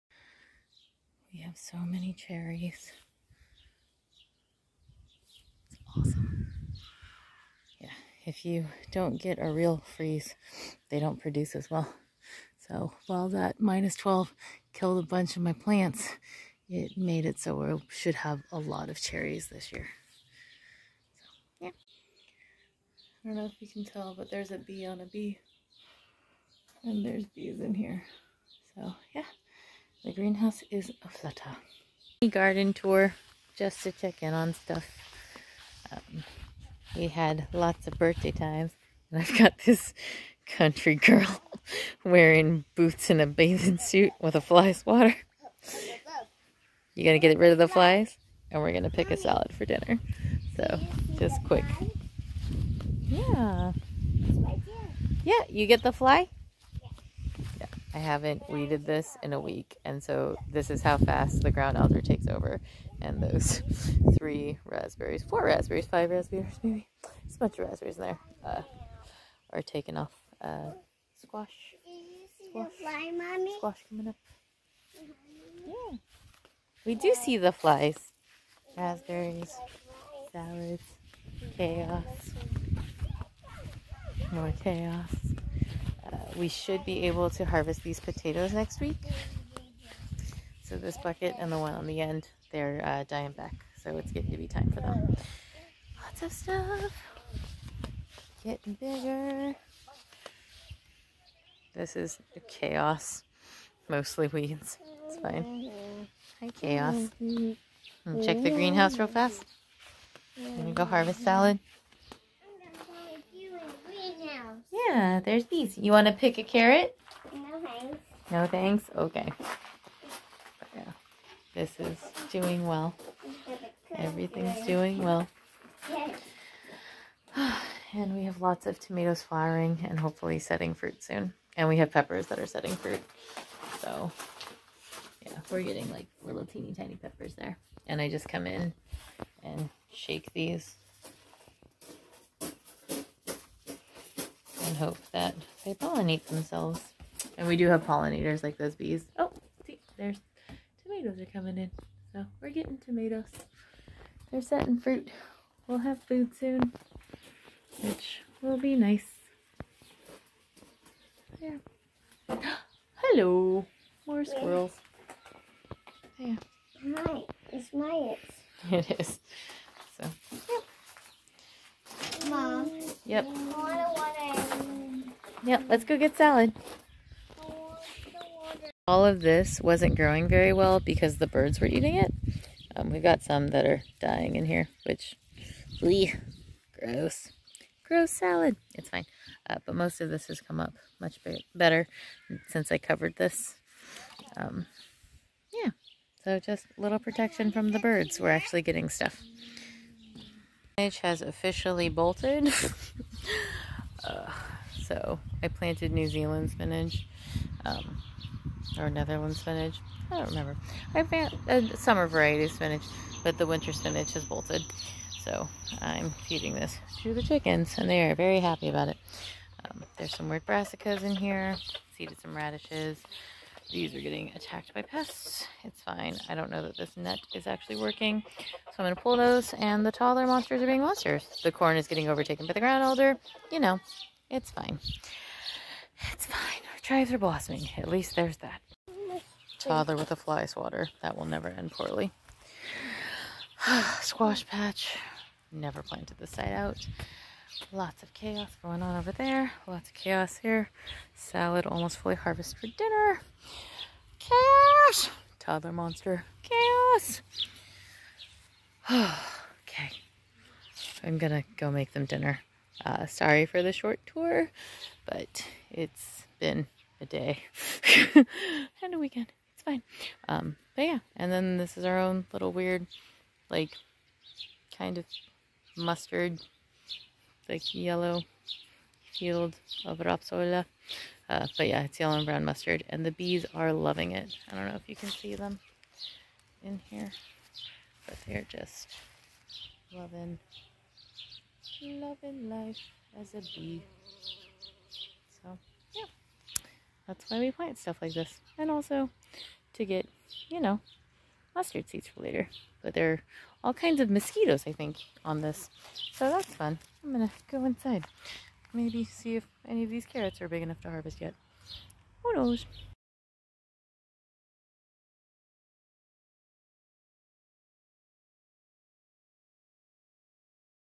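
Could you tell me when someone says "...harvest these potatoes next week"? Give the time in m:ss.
1:27.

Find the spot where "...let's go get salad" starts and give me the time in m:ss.
2:55.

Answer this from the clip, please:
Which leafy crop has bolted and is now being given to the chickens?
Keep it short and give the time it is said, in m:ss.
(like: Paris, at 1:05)
winter spinach, at 3:33.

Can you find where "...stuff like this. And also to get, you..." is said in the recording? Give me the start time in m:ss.
4:57.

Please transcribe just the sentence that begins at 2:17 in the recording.
And I just come in and shake these and hope that they pollinate themselves.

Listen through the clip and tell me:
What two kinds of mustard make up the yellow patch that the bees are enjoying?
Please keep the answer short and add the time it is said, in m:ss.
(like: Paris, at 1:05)
yellow and brown, at 4:41.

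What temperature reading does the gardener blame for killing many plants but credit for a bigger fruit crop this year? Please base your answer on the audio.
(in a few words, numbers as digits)
-12.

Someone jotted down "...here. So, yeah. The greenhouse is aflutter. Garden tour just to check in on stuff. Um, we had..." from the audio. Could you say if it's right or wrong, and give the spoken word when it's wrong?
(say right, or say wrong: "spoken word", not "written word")
right.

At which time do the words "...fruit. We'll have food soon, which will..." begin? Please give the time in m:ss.
2:34.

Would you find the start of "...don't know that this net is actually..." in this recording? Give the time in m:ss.
3:46.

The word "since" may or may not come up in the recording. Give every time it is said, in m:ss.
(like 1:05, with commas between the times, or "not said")
3:12.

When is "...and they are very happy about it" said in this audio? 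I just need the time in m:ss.
3:37.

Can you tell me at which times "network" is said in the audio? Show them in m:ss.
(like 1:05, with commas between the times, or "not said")
not said.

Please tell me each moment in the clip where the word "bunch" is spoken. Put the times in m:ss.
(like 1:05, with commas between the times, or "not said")
0:15, 1:07.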